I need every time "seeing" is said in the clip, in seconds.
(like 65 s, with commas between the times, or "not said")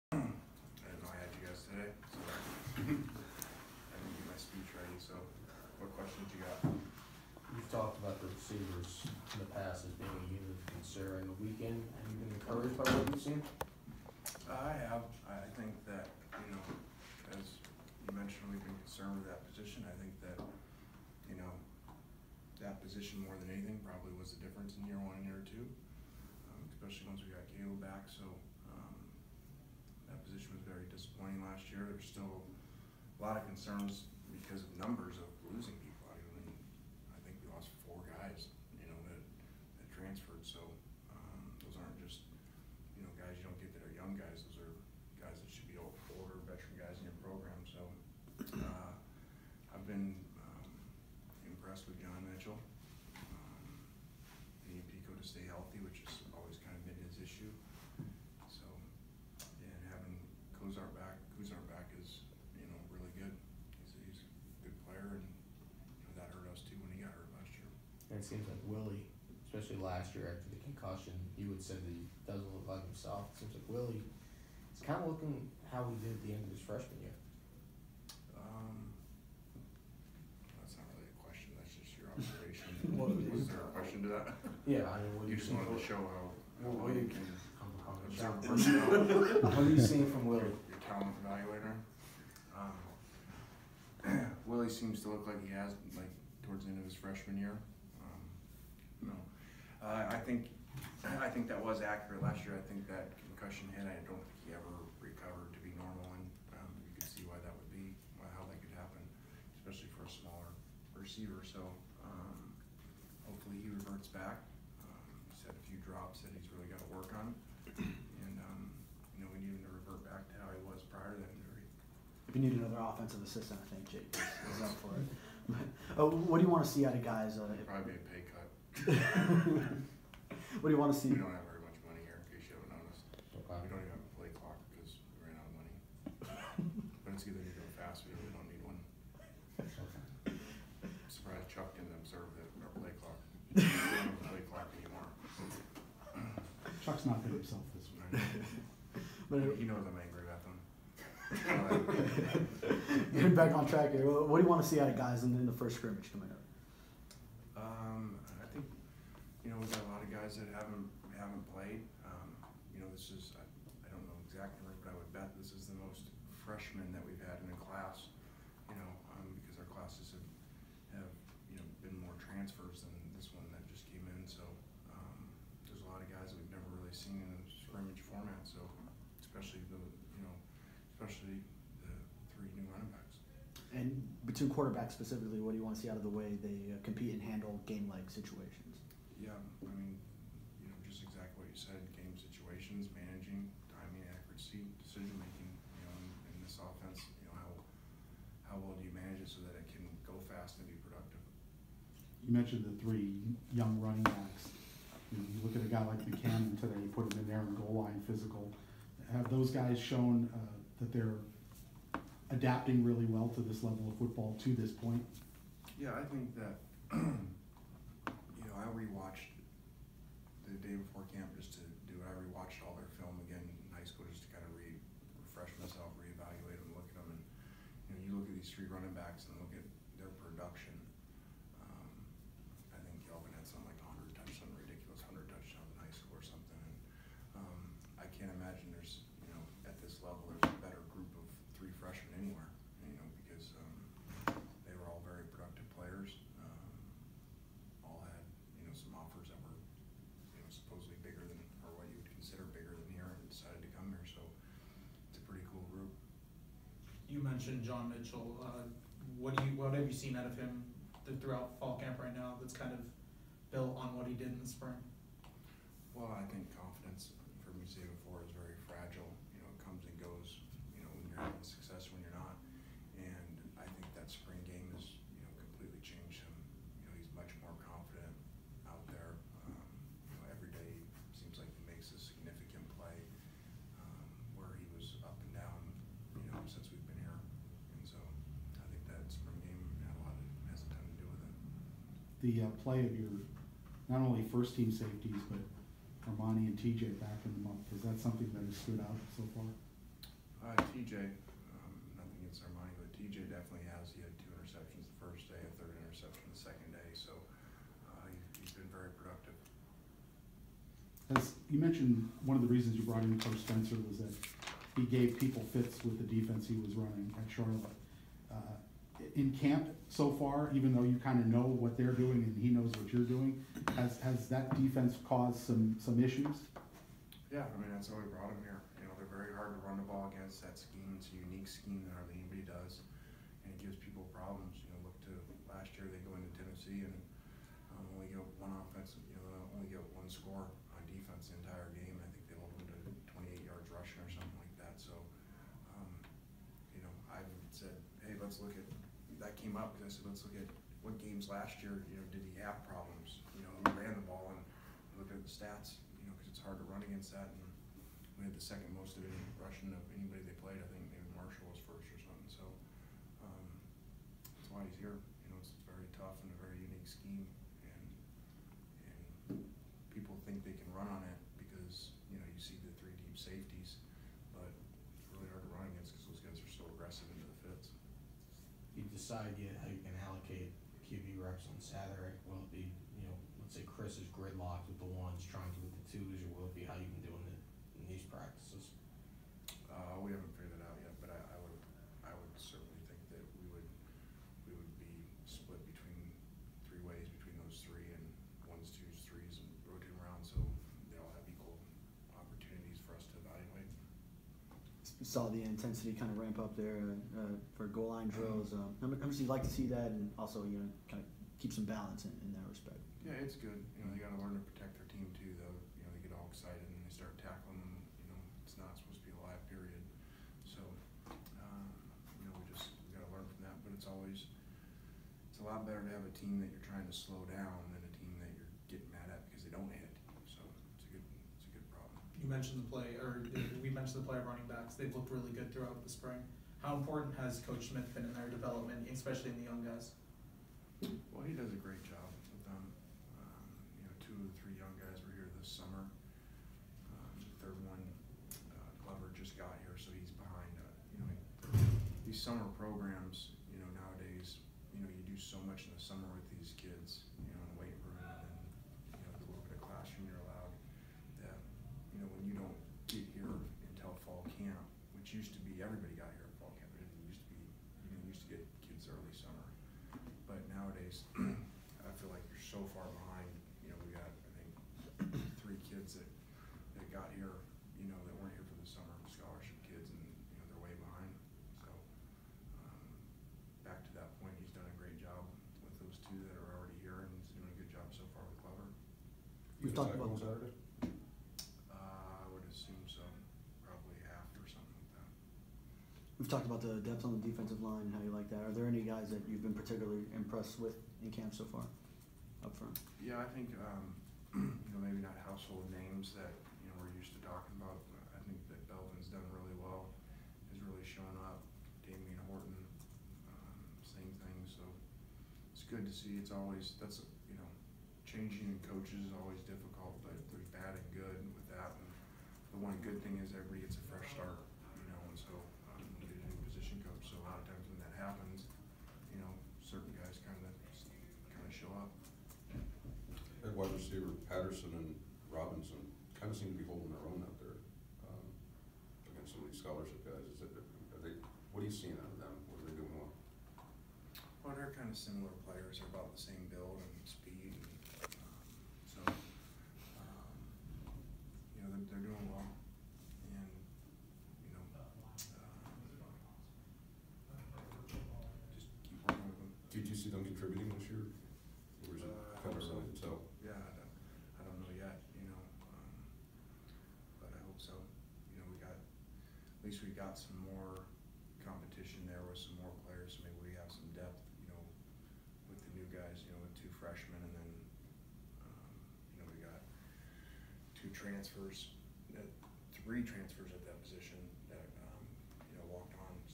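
89 s, 541 s.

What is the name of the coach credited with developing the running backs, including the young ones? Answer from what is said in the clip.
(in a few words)
Coach Smith.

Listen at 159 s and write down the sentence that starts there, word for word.
you know, we've got a lot of guys that haven't haven't played.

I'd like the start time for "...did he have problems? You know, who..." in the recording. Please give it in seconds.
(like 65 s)
352 s.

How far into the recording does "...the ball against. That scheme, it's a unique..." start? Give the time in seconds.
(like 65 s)
329 s.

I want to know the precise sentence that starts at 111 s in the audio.
So um, hopefully he reverts back.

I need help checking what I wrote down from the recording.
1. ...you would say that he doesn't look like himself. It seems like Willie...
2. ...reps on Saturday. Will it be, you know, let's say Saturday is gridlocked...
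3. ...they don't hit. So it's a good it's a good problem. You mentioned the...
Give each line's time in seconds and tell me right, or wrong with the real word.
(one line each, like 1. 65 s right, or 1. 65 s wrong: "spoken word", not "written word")
1. 71 s right
2. 381 s wrong: "Chris", not "Saturday"
3. 429 s right.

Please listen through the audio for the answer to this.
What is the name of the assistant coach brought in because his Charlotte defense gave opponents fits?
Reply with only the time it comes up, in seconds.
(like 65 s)
313 s.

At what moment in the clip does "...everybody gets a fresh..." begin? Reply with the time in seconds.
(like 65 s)
523 s.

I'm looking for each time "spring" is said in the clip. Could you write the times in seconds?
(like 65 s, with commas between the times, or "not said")
264 s, 435 s.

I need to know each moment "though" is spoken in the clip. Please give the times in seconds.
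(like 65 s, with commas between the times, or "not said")
320 s, 415 s.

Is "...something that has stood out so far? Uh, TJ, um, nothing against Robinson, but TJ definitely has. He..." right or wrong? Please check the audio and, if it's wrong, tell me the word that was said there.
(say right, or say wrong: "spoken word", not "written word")
wrong: "Armani", not "Robinson".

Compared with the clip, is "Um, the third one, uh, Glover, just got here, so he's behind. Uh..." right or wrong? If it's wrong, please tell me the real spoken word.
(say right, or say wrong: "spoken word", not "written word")
right.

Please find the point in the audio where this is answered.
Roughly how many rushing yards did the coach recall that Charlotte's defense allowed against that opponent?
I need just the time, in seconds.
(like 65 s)
343 s.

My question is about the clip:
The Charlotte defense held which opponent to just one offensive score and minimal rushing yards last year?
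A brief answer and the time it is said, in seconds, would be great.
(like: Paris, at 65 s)
Tennessee, at 336 s.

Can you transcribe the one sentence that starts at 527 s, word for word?
So a lot of times when that happens, you know, certain guys kind of kind of show up.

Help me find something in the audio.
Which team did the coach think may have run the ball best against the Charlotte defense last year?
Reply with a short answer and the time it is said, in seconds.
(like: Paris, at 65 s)
Marshall, at 361 s.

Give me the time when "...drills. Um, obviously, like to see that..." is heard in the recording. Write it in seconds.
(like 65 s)
408 s.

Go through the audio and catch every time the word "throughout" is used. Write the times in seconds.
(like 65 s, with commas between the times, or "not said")
261 s, 435 s.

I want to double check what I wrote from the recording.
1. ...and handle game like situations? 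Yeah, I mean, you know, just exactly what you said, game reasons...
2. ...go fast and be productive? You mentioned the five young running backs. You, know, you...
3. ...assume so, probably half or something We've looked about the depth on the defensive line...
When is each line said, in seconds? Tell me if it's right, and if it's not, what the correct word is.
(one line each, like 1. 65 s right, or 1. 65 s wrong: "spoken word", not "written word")
1. 187 s wrong: "situations", not "reasons"
2. 200 s wrong: "three", not "five"
3. 492 s wrong: "talked", not "looked".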